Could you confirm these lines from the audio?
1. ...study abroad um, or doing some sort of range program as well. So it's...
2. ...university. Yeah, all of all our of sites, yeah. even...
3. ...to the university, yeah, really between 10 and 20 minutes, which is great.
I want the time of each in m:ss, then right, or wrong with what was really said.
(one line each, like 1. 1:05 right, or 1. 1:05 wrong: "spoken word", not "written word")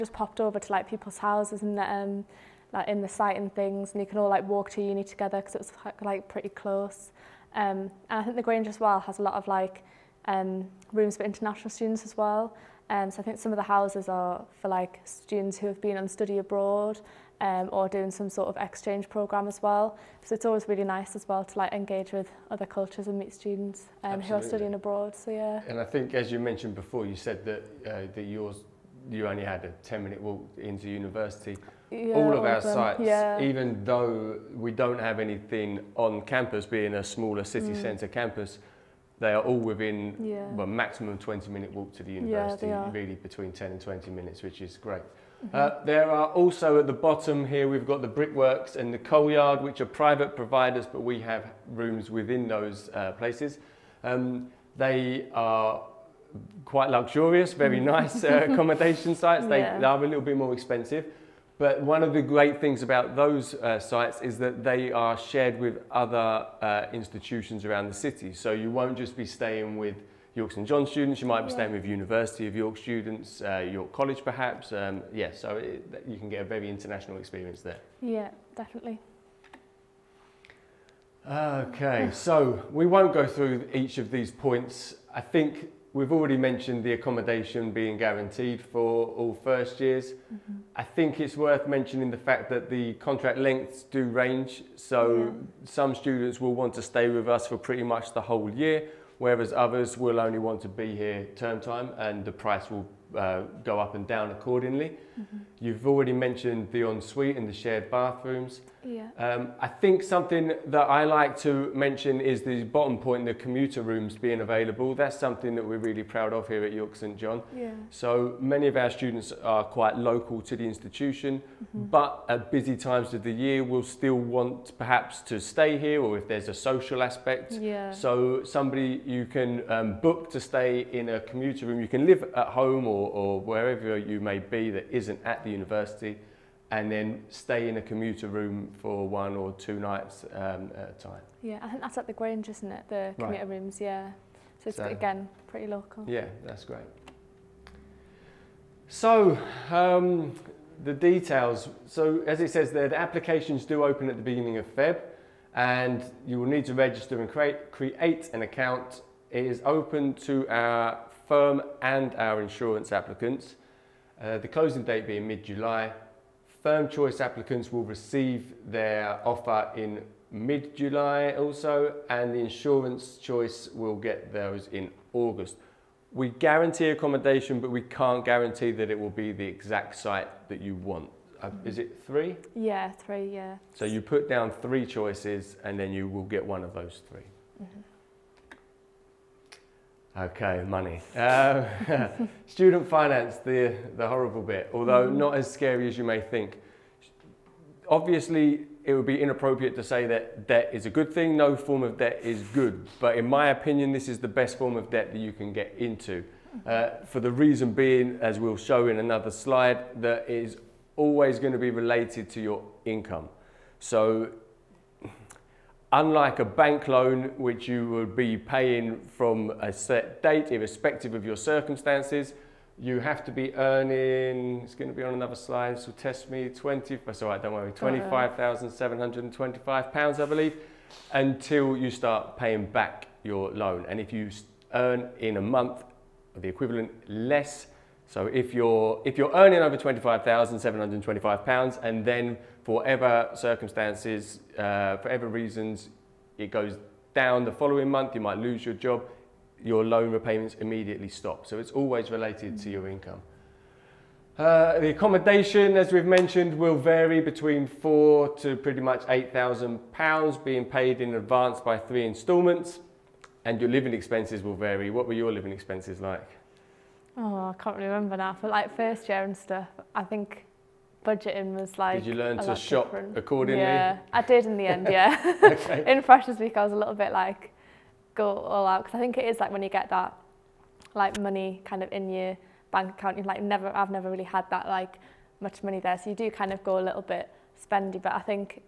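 1. 0:16 wrong: "exchange", not "range"
2. 0:30 right
3. 0:41 right.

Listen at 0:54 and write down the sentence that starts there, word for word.
Um, they are quite luxurious, very mm.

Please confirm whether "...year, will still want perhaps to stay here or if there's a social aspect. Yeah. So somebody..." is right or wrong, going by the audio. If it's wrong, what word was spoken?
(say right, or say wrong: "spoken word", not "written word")
right.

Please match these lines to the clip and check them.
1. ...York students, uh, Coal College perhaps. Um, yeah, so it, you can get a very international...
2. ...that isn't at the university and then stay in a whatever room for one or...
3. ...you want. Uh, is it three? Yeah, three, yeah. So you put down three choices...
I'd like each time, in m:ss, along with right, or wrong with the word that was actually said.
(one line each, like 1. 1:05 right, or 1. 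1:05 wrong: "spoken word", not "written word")
1. 1:12 wrong: "York", not "Coal"
2. 2:14 wrong: "commuter", not "whatever"
3. 3:00 right.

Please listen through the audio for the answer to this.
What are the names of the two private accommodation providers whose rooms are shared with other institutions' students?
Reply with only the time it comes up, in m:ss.
0:48.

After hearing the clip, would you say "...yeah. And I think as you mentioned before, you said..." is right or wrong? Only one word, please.
right.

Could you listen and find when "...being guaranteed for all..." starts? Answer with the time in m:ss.
1:27.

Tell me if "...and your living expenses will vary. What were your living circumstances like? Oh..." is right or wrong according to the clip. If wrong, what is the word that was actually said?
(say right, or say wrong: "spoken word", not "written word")
wrong: "expenses", not "circumstances".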